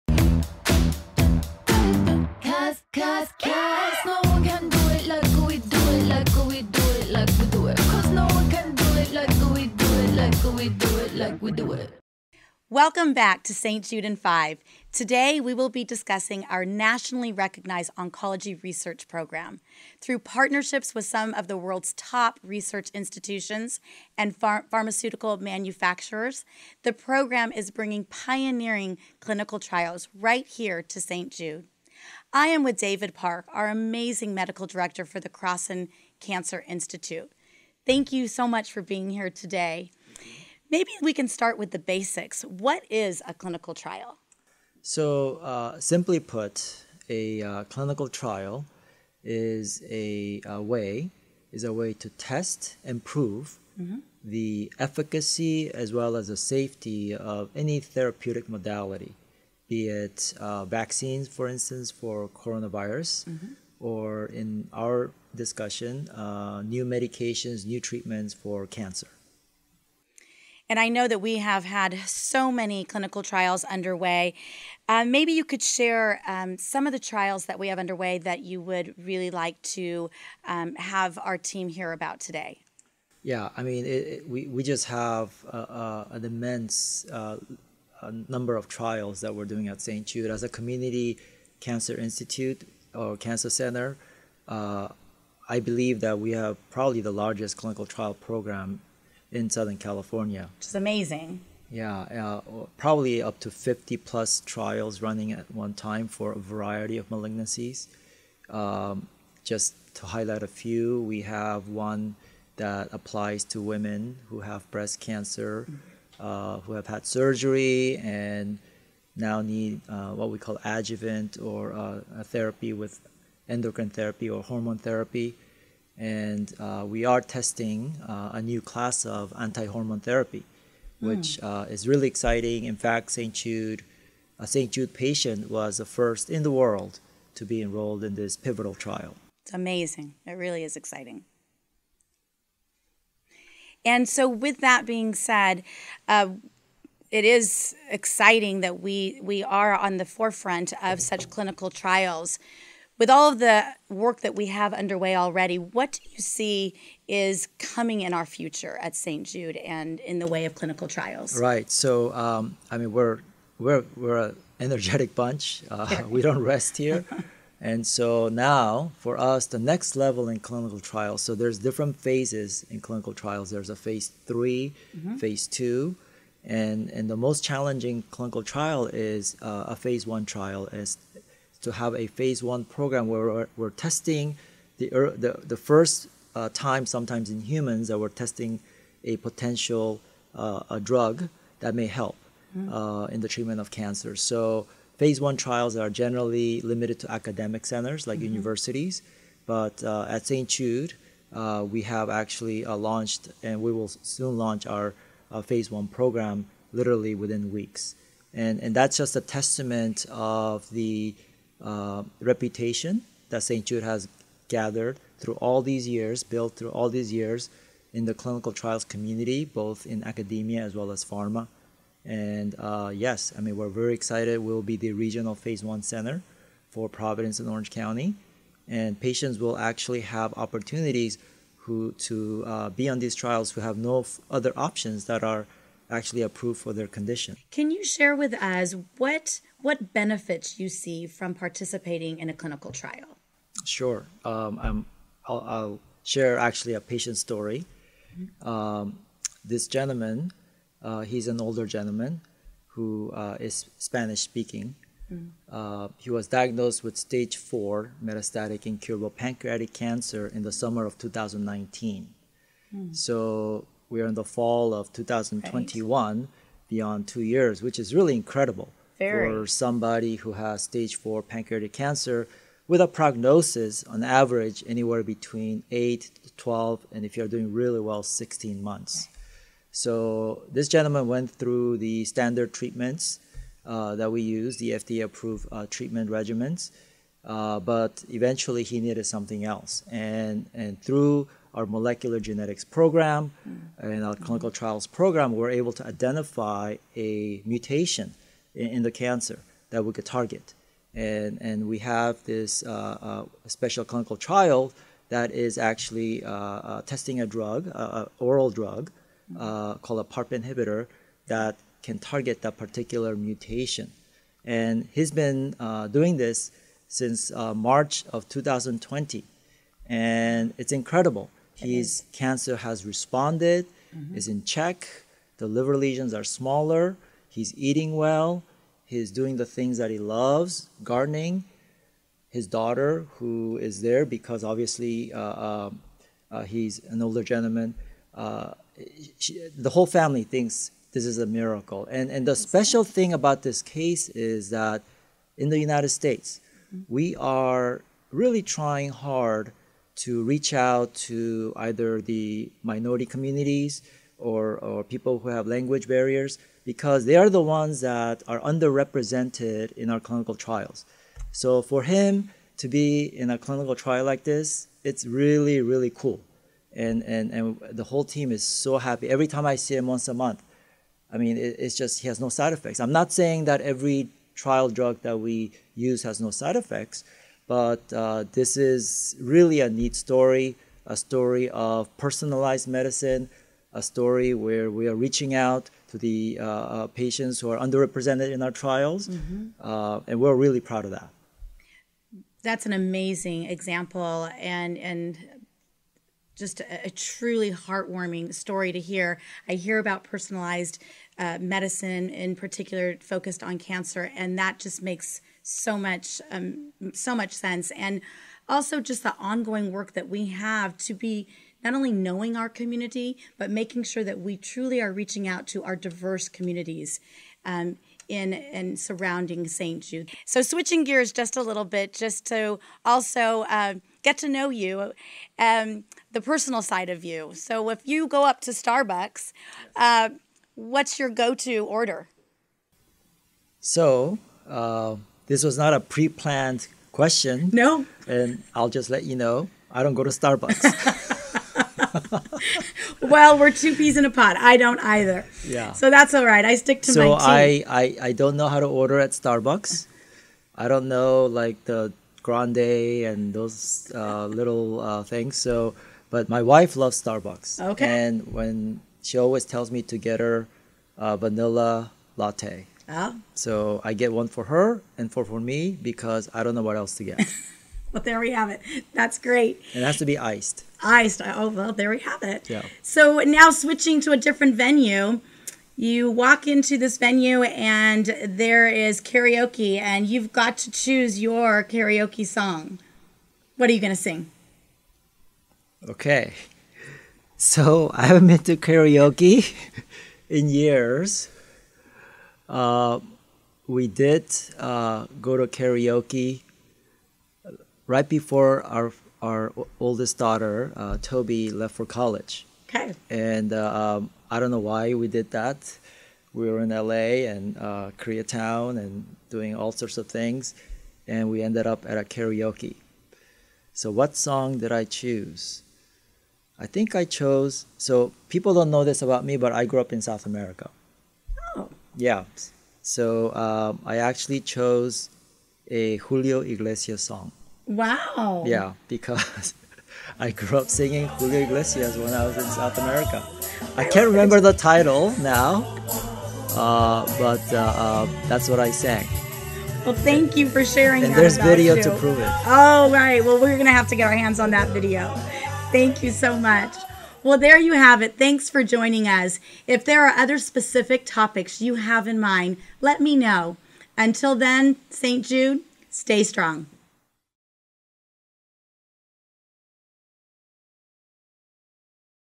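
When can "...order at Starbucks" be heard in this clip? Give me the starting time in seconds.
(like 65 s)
448 s.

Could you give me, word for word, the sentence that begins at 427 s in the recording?
So, if you go up to Starbucks, uh, what's your go to order?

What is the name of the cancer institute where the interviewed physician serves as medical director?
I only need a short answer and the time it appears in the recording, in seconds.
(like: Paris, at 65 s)
Crosson Cancer Institute, at 35 s.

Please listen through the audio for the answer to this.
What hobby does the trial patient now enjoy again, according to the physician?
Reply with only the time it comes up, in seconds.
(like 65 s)
330 s.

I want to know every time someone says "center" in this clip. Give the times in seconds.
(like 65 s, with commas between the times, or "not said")
93 s, 197 s, 225 s.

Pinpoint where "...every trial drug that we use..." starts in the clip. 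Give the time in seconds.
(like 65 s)
373 s.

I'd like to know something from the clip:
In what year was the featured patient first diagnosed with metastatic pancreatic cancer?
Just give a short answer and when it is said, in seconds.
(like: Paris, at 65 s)
2019, at 260 s.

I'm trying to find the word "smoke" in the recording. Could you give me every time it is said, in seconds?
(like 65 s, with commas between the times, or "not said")
not said.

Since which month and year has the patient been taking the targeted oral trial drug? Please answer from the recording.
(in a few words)
March 2020.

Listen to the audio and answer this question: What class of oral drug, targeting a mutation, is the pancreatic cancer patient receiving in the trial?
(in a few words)
PARP inhibitor.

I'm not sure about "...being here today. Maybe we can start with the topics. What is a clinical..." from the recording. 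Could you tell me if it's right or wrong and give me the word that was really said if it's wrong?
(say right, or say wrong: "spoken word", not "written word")
wrong: "basics", not "topics".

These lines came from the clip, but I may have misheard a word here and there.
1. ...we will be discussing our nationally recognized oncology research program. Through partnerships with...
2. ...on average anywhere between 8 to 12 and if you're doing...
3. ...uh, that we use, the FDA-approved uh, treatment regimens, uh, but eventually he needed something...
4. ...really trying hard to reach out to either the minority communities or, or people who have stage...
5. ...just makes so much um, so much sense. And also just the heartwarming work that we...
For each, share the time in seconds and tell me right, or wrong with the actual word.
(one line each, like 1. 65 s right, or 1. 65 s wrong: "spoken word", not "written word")
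1. 15 s right
2. 273 s right
3. 283 s right
4. 348 s wrong: "language", not "stage"
5. 404 s wrong: "ongoing", not "heartwarming".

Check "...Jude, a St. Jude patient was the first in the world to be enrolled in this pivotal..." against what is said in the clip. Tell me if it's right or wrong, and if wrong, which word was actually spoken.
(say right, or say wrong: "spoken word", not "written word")
right.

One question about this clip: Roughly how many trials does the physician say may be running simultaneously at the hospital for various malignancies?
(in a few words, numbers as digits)
50 plus.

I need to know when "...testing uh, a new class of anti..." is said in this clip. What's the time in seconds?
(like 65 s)
127 s.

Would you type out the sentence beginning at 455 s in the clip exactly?
So, but my wife loves Starbucks.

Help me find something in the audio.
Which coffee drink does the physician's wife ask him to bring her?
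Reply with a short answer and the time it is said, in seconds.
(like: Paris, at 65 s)
vanilla latte, at 461 s.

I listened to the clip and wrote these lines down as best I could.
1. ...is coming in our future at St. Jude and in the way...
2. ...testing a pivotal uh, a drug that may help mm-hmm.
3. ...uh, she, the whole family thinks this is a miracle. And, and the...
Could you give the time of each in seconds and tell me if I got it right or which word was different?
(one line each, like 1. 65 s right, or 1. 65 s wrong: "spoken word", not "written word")
1. 157 s right
2. 188 s wrong: "potential", not "pivotal"
3. 338 s right.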